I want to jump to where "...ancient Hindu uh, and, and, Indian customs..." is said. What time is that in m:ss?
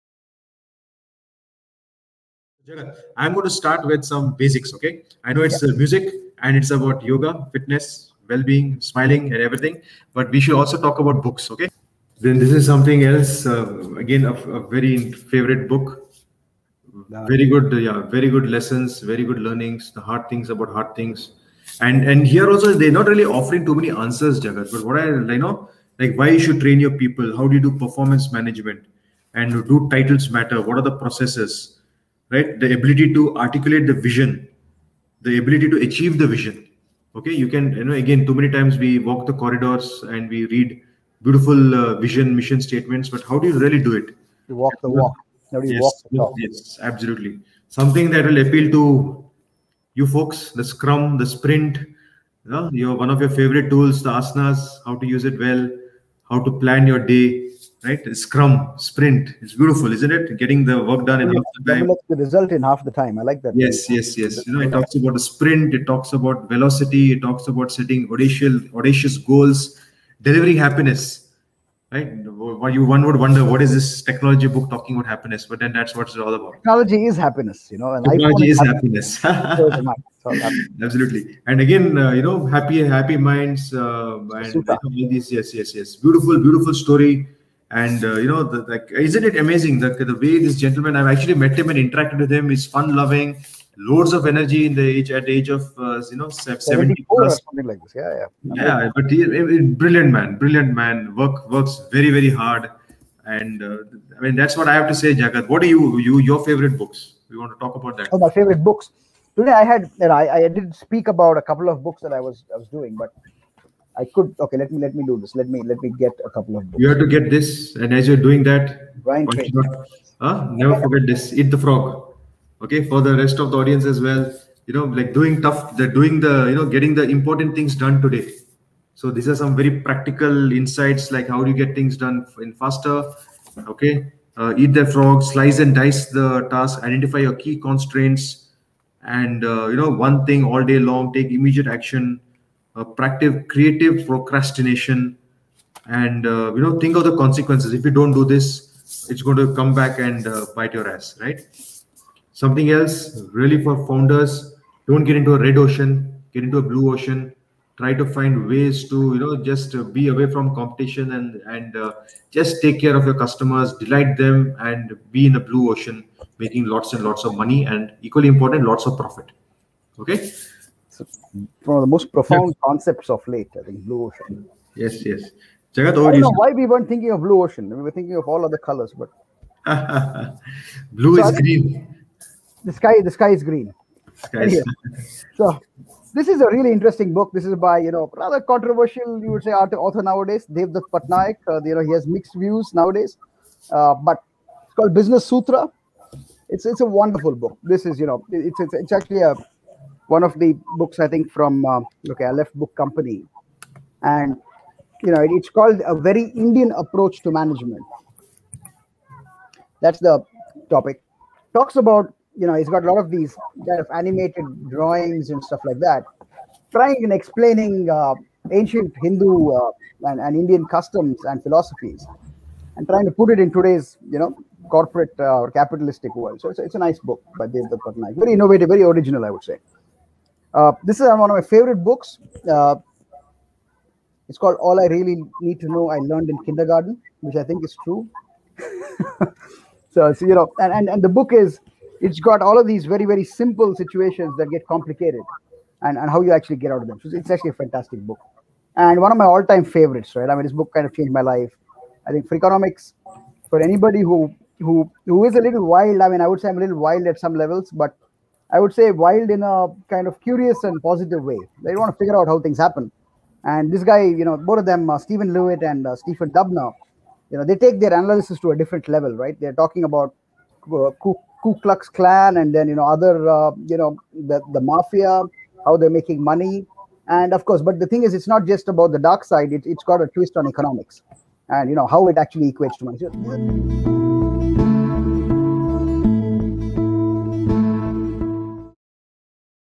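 3:38.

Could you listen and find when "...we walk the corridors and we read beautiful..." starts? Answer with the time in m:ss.
0:38.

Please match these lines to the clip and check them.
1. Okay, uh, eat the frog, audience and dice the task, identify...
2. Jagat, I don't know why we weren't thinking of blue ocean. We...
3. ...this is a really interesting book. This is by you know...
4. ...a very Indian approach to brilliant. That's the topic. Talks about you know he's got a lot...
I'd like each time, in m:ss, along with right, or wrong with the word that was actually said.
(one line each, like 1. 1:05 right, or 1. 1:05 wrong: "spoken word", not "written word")
1. 2:13 wrong: "slice", not "audience"
2. 2:55 right
3. 3:06 right
4. 3:25 wrong: "management", not "brilliant".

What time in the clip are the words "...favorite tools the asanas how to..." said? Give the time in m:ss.
0:53.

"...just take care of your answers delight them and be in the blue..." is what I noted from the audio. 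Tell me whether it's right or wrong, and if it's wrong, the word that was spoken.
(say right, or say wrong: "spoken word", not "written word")
wrong: "customers", not "answers".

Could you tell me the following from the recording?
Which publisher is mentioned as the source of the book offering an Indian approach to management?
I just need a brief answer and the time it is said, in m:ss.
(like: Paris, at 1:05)
Aleph Book Company, at 3:22.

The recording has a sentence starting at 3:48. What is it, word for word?
Very innovative, very original, I would say.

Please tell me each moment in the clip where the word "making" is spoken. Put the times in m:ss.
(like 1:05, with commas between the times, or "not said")
2:46, 4:35.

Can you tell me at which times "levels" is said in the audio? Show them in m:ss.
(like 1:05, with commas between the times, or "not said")
4:17, 4:28.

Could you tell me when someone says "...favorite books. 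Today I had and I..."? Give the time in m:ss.
1:48.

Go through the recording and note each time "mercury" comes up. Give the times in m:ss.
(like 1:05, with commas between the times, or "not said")
not said.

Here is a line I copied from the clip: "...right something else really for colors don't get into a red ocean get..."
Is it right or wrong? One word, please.
wrong.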